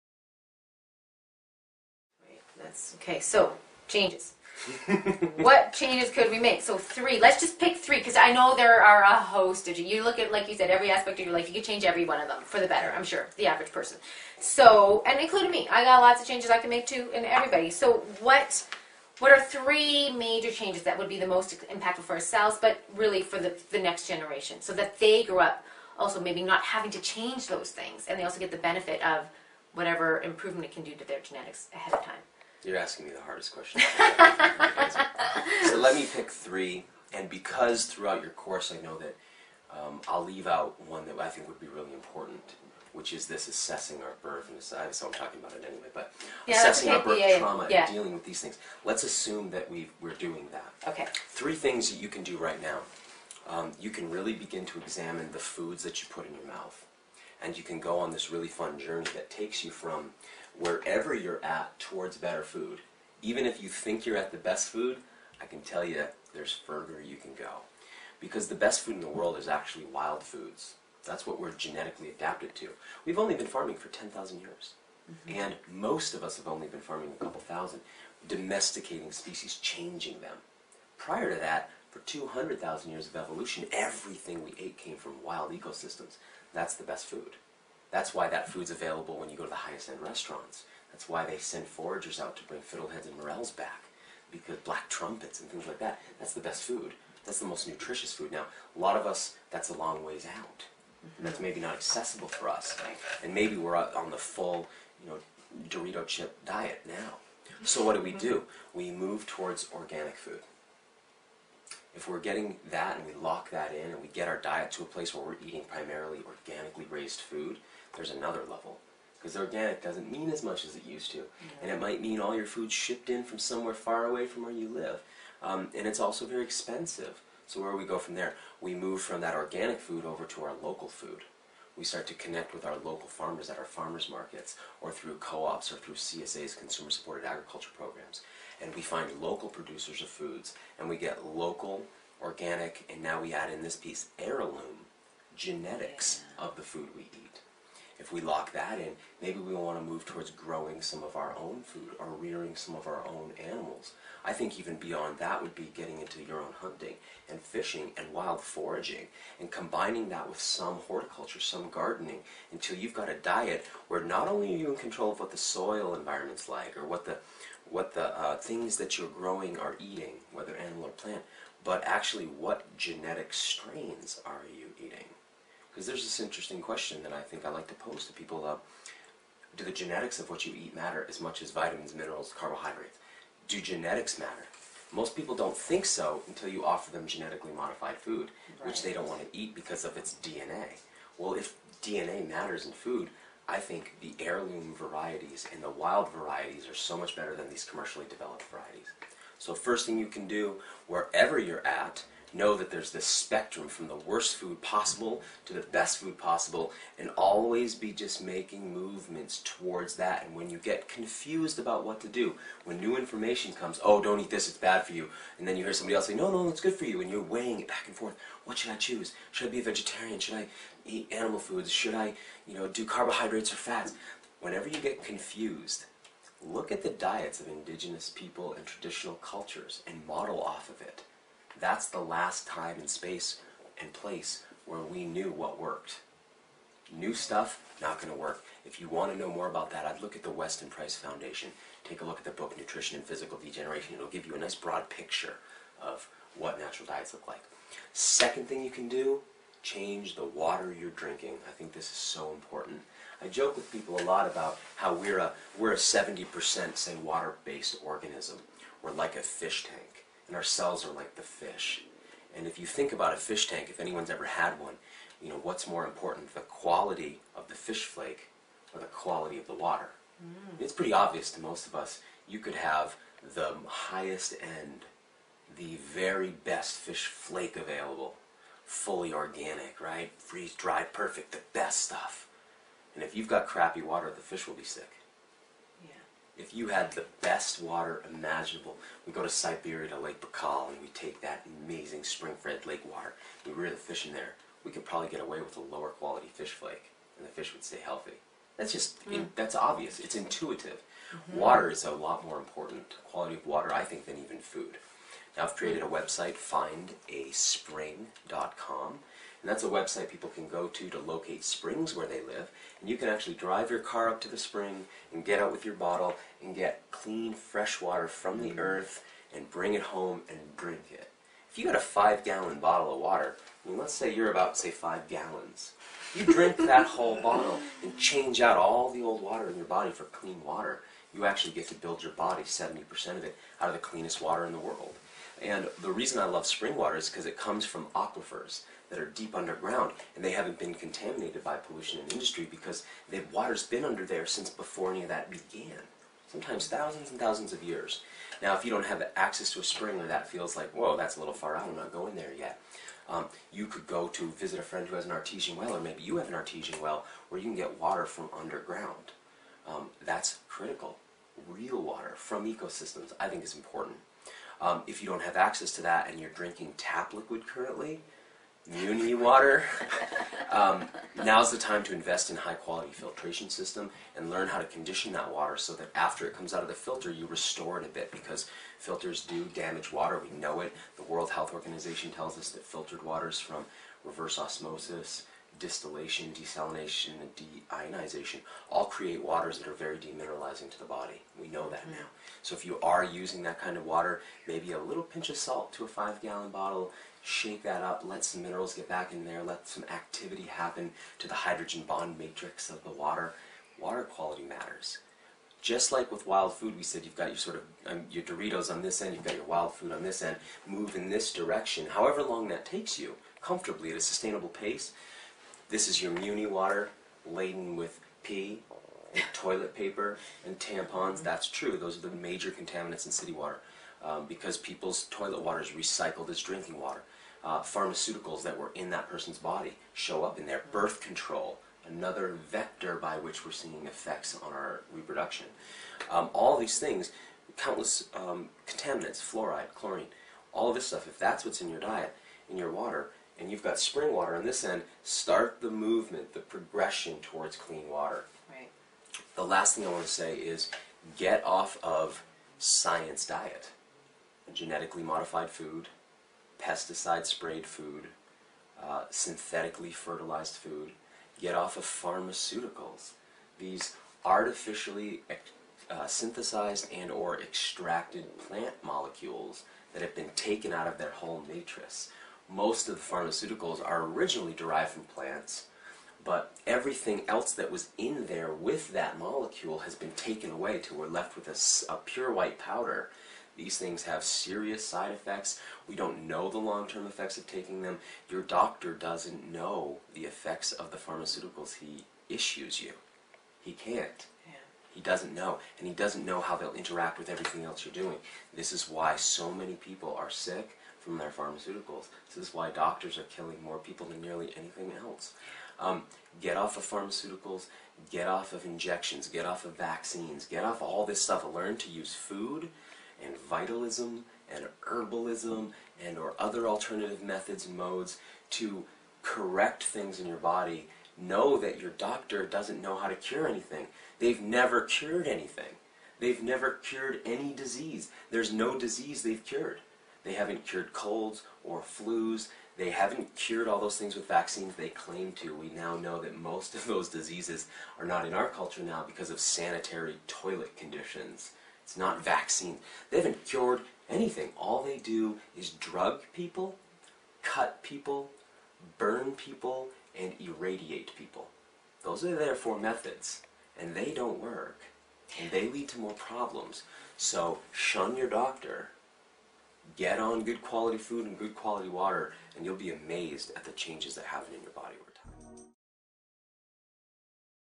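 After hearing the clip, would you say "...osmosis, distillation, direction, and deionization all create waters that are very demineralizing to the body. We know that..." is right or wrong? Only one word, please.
wrong.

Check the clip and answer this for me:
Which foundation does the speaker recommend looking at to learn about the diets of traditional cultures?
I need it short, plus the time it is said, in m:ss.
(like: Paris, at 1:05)
Weston Price Foundation, at 4:00.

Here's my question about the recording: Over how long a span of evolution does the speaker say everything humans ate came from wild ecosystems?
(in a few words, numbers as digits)
200,000 years.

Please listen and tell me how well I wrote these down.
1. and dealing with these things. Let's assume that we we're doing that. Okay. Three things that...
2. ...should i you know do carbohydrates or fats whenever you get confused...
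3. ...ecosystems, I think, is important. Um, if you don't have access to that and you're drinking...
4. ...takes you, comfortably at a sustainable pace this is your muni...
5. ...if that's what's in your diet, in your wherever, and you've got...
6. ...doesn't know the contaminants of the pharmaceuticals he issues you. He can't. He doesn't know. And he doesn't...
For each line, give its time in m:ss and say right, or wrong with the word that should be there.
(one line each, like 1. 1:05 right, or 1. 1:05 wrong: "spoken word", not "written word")
1. 0:47 right
2. 3:41 right
3. 6:02 right
4. 6:52 right
5. 7:21 wrong: "water", not "wherever"
6. 8:08 wrong: "effects", not "contaminants".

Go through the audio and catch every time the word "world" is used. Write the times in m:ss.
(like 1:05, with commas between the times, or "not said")
1:09, 5:34, 6:21.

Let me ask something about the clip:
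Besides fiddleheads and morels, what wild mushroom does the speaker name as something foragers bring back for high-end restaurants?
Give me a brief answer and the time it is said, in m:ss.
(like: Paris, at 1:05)
Black trumpets, at 1:34.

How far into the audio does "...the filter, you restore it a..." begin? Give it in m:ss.
6:16.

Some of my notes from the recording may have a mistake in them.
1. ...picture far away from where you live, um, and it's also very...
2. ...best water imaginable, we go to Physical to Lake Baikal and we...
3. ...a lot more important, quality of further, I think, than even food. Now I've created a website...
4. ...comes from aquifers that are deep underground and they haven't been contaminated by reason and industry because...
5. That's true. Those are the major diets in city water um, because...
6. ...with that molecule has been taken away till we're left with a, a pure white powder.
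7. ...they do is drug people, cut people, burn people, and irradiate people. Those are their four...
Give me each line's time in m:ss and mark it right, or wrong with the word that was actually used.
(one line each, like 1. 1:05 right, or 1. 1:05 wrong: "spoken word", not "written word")
1. 2:03 wrong: "somewhere", not "picture"
2. 4:47 wrong: "Siberia", not "Physical"
3. 5:01 wrong: "water", not "further"
4. 5:37 wrong: "pollution", not "reason"
5. 7:01 wrong: "contaminants", not "diets"
6. 7:58 right
7. 9:04 right.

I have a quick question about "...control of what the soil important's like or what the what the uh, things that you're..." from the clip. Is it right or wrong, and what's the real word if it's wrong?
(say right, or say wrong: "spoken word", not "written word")
wrong: "environment", not "important".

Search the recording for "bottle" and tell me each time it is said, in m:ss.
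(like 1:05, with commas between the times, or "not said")
5:15, 5:22, 5:27, 6:36.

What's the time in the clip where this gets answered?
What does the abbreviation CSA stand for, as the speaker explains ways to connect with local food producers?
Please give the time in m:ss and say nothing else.
2:16.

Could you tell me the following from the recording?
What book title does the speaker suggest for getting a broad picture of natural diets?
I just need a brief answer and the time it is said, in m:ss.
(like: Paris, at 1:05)
Nutrition and Physical Degeneration, at 4:02.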